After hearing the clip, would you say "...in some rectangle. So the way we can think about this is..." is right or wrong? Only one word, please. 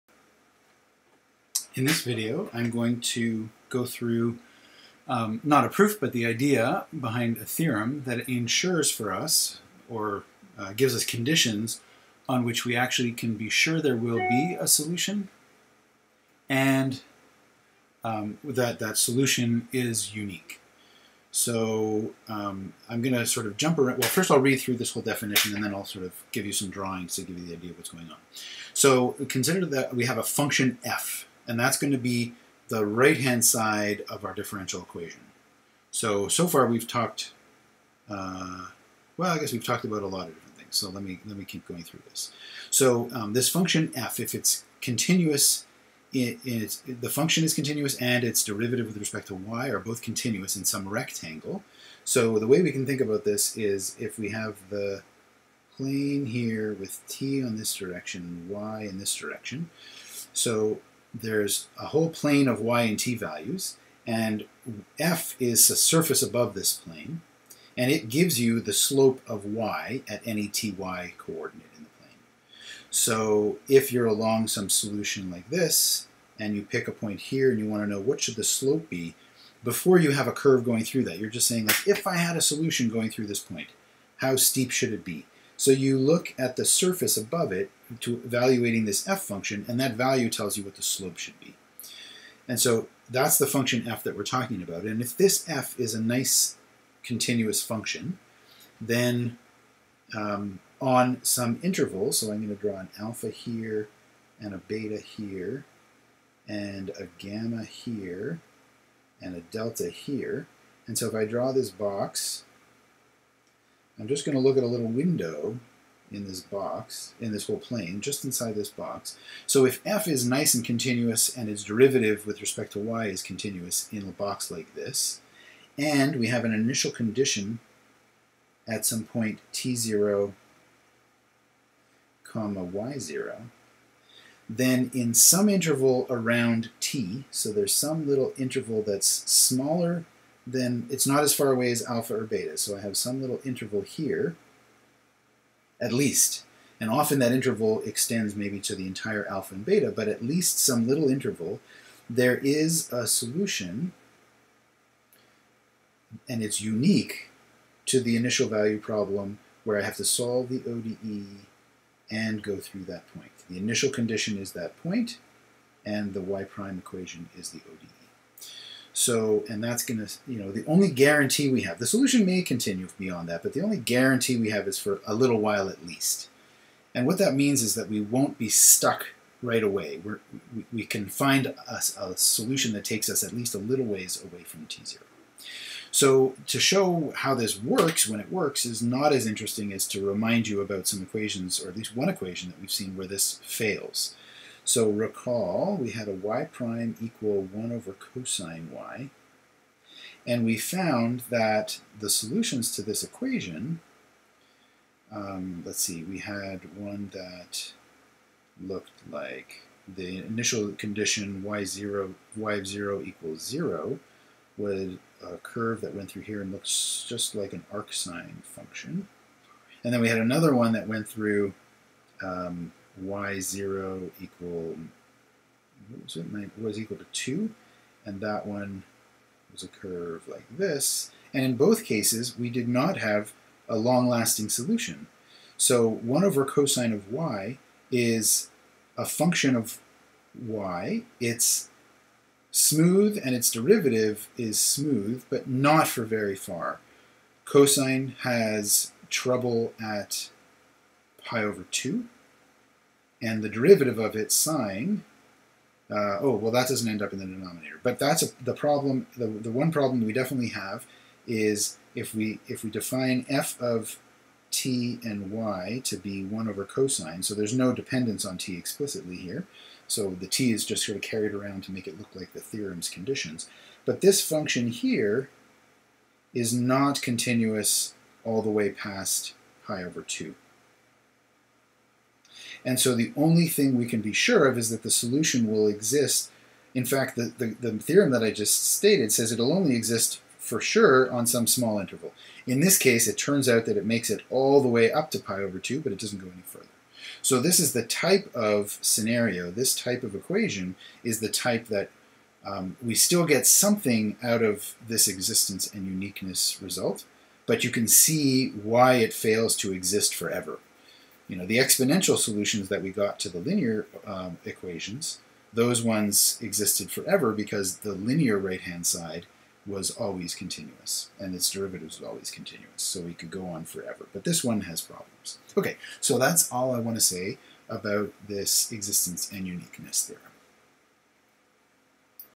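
right.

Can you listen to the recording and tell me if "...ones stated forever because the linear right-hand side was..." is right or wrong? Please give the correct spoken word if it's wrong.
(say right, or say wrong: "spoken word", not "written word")
wrong: "existed", not "stated".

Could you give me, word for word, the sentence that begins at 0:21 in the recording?
So um, I'm going to sort of jump around.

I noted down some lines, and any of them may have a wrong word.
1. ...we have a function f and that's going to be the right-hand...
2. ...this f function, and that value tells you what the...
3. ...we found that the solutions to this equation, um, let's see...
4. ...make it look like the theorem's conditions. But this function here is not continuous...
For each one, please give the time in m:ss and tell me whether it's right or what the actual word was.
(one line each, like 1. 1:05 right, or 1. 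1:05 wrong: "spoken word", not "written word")
1. 0:29 right
2. 1:28 right
3. 3:20 right
4. 4:31 right.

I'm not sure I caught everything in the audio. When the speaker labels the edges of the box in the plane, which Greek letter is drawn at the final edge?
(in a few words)
delta.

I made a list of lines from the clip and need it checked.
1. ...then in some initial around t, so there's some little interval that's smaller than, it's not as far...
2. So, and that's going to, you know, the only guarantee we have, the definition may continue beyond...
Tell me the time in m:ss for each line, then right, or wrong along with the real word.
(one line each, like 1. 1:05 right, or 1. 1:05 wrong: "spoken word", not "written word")
1. 2:14 wrong: "interval", not "initial"
2. 2:49 wrong: "solution", not "definition".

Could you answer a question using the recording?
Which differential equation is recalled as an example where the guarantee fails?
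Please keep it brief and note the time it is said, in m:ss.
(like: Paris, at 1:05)
y prime equal 1 over cosine y, at 3:16.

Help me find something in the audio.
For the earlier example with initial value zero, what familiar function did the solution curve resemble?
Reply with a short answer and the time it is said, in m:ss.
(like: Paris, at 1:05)
arcsine, at 3:37.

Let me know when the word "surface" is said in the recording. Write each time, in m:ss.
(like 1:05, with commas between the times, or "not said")
1:05, 1:26.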